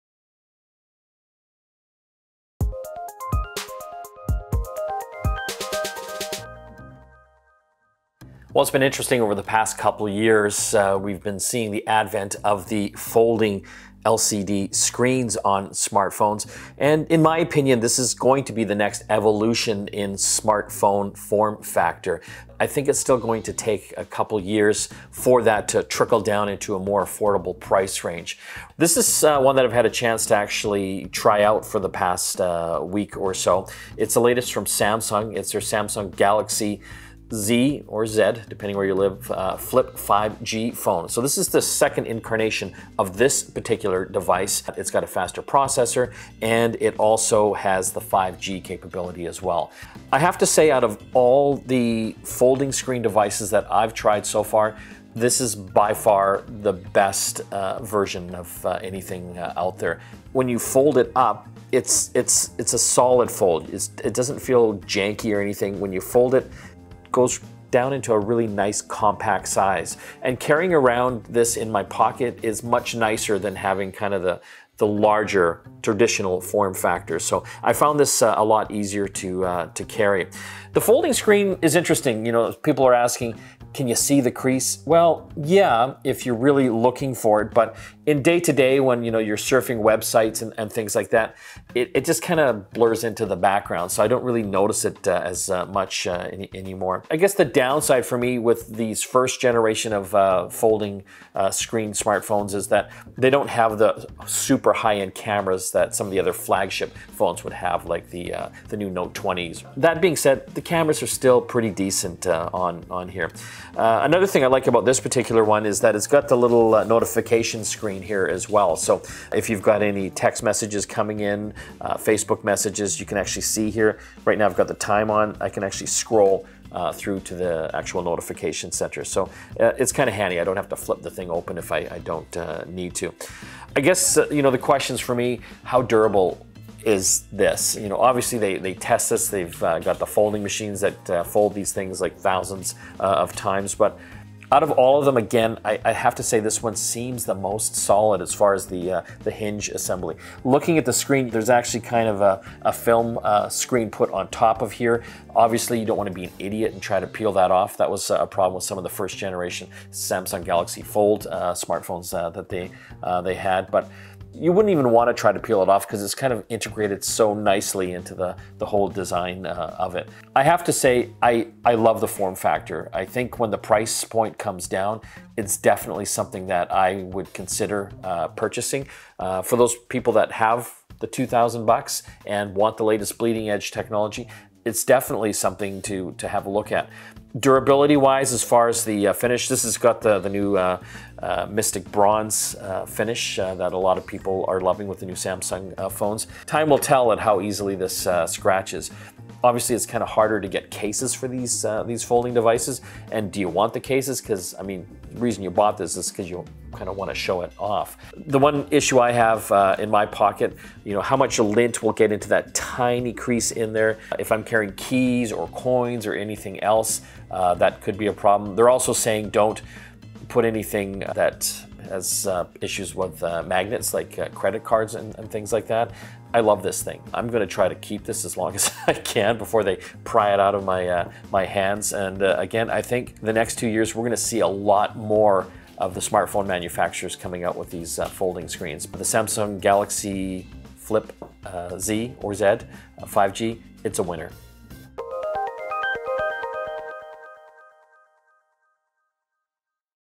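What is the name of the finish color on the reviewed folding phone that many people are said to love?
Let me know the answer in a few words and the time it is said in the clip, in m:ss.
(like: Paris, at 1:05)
Mystic Bronze, at 3:11.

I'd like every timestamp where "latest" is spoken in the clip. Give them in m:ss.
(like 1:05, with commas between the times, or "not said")
0:34, 3:02.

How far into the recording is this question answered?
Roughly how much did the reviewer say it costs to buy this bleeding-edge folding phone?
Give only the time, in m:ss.
3:01.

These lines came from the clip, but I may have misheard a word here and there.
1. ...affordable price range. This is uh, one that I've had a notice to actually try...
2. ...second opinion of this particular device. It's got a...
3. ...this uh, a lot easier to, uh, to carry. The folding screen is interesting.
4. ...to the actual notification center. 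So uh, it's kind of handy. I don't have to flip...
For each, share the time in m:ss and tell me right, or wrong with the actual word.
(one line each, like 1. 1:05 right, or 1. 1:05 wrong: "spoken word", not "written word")
1. 0:27 wrong: "chance", not "notice"
2. 0:41 wrong: "incarnation", not "opinion"
3. 1:17 right
4. 2:07 right.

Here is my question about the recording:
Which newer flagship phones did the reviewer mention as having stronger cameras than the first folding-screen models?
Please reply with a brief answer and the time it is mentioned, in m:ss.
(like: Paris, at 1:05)
Note 20s, at 1:48.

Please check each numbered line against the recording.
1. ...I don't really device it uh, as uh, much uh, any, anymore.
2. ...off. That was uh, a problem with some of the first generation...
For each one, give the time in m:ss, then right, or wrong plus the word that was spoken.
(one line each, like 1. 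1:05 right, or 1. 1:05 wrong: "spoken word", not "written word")
1. 1:34 wrong: "notice", not "device"
2. 2:37 right.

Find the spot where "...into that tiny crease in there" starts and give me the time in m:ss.
3:32.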